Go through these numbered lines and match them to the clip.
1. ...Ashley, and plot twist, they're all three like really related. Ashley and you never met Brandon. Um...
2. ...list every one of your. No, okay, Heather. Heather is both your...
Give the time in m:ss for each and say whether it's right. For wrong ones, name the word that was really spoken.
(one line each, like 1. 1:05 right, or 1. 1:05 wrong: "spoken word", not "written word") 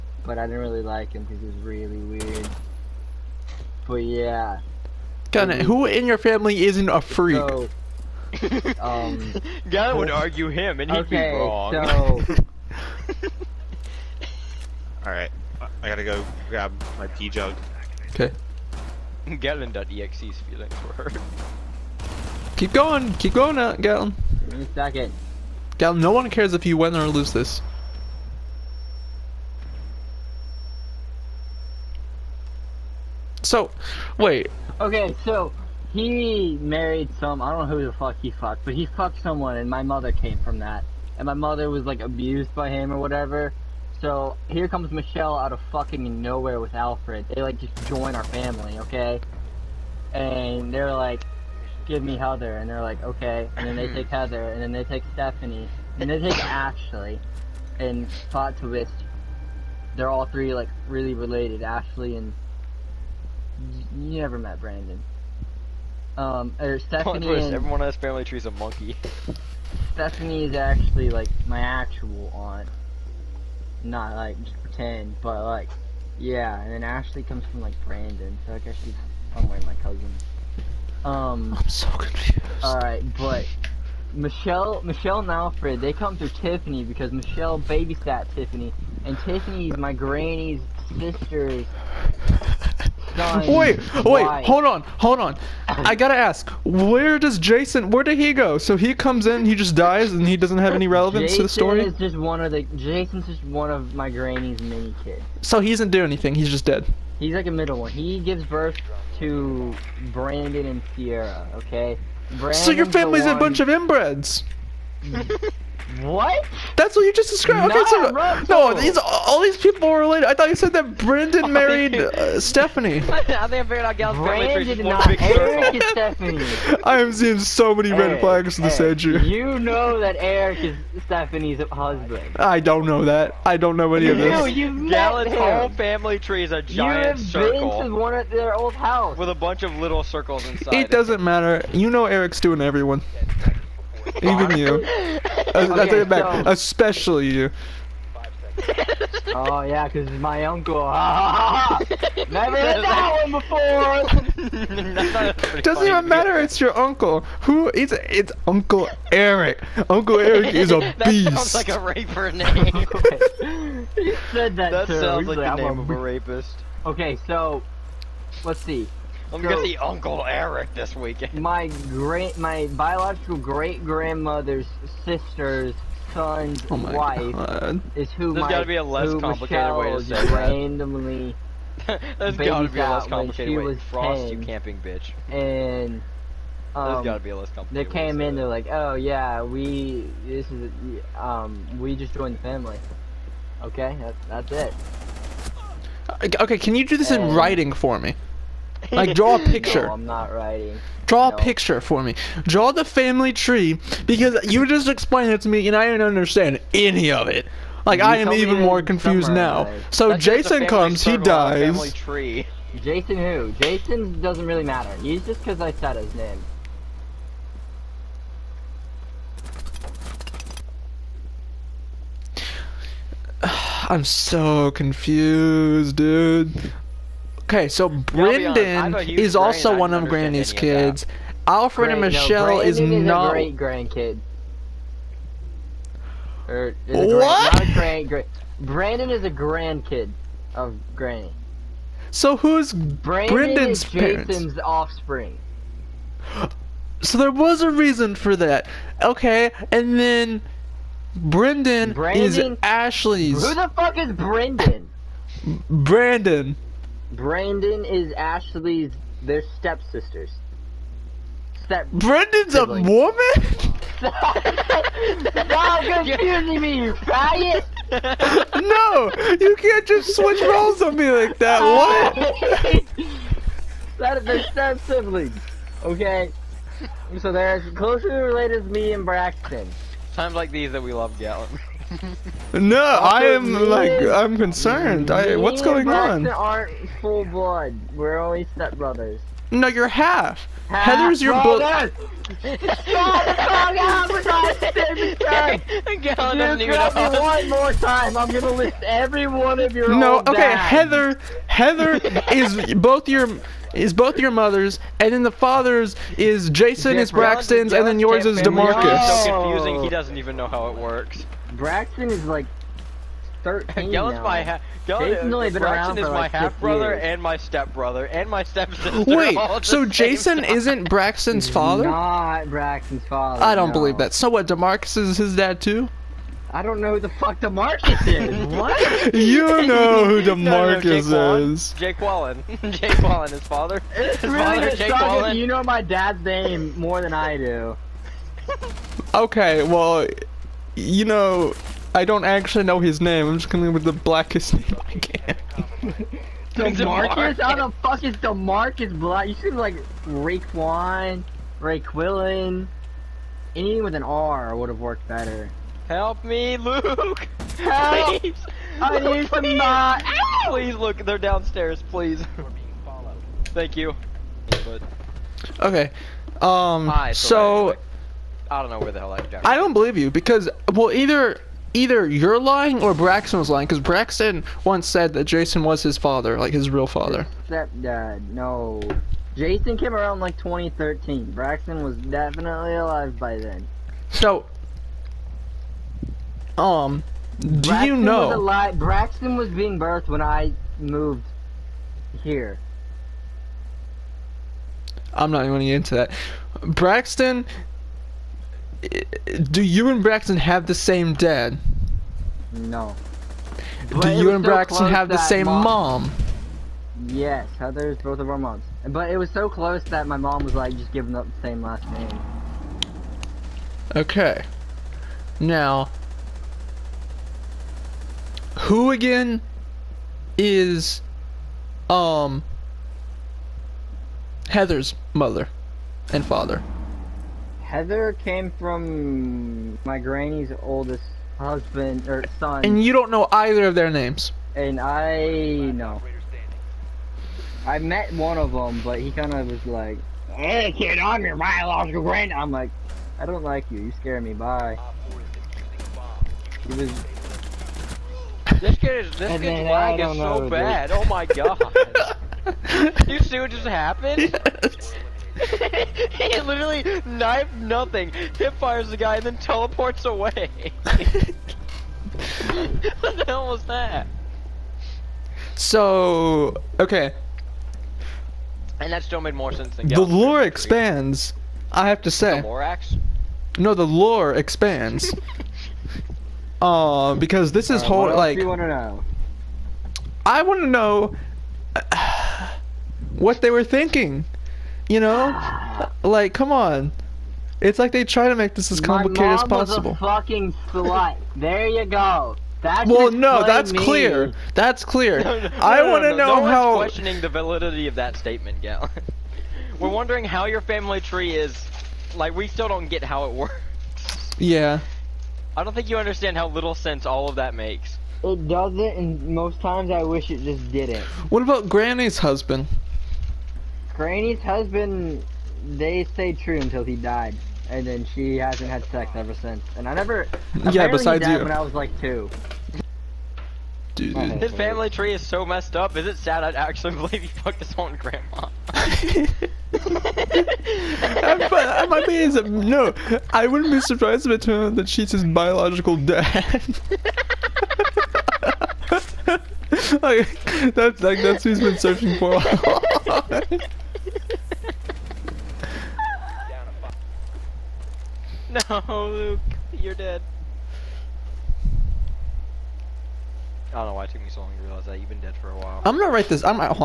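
1. 0:56 right
2. 4:58 right.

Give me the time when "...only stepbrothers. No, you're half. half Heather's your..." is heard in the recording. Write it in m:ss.
4:48.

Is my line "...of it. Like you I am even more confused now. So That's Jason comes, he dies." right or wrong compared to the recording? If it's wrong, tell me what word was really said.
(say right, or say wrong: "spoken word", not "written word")
right.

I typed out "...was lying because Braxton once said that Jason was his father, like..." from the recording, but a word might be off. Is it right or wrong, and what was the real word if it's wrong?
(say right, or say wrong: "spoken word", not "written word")
right.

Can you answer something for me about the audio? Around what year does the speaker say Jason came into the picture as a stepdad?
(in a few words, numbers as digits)
2013.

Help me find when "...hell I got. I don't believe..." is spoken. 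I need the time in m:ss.
6:08.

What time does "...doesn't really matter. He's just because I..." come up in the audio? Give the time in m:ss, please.
3:34.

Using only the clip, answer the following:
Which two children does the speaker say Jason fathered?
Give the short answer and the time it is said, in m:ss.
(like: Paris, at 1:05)
Brandon and Sierra, at 1:50.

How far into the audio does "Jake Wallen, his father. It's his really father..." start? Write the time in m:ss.
5:32.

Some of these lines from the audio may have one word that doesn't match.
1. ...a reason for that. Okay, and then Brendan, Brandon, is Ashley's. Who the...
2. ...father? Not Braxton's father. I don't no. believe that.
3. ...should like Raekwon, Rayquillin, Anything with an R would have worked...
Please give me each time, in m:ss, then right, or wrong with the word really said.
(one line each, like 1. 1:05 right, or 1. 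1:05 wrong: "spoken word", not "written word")
1. 4:07 right
2. 5:21 right
3. 5:49 right.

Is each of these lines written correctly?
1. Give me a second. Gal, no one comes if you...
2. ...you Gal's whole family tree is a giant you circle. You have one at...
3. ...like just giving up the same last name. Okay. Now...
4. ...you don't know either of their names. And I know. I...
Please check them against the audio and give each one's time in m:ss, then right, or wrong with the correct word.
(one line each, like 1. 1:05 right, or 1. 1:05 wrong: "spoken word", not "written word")
1. 0:24 wrong: "cares", not "comes"
2. 2:14 right
3. 6:50 right
4. 7:12 right.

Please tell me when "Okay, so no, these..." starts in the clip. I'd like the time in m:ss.
1:57.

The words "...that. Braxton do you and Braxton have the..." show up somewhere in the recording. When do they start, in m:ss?
6:35.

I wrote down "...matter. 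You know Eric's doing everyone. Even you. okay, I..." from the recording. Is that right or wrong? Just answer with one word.
right.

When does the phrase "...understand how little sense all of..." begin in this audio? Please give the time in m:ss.
8:25.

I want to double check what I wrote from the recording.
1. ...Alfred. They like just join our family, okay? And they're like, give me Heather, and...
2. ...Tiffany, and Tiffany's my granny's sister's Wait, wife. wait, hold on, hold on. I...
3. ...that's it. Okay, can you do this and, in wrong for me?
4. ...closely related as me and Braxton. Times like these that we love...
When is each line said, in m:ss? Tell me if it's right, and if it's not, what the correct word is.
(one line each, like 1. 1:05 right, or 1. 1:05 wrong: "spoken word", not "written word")
1. 0:46 right
2. 1:28 right
3. 3:14 wrong: "writing", not "wrong"
4. 4:37 right.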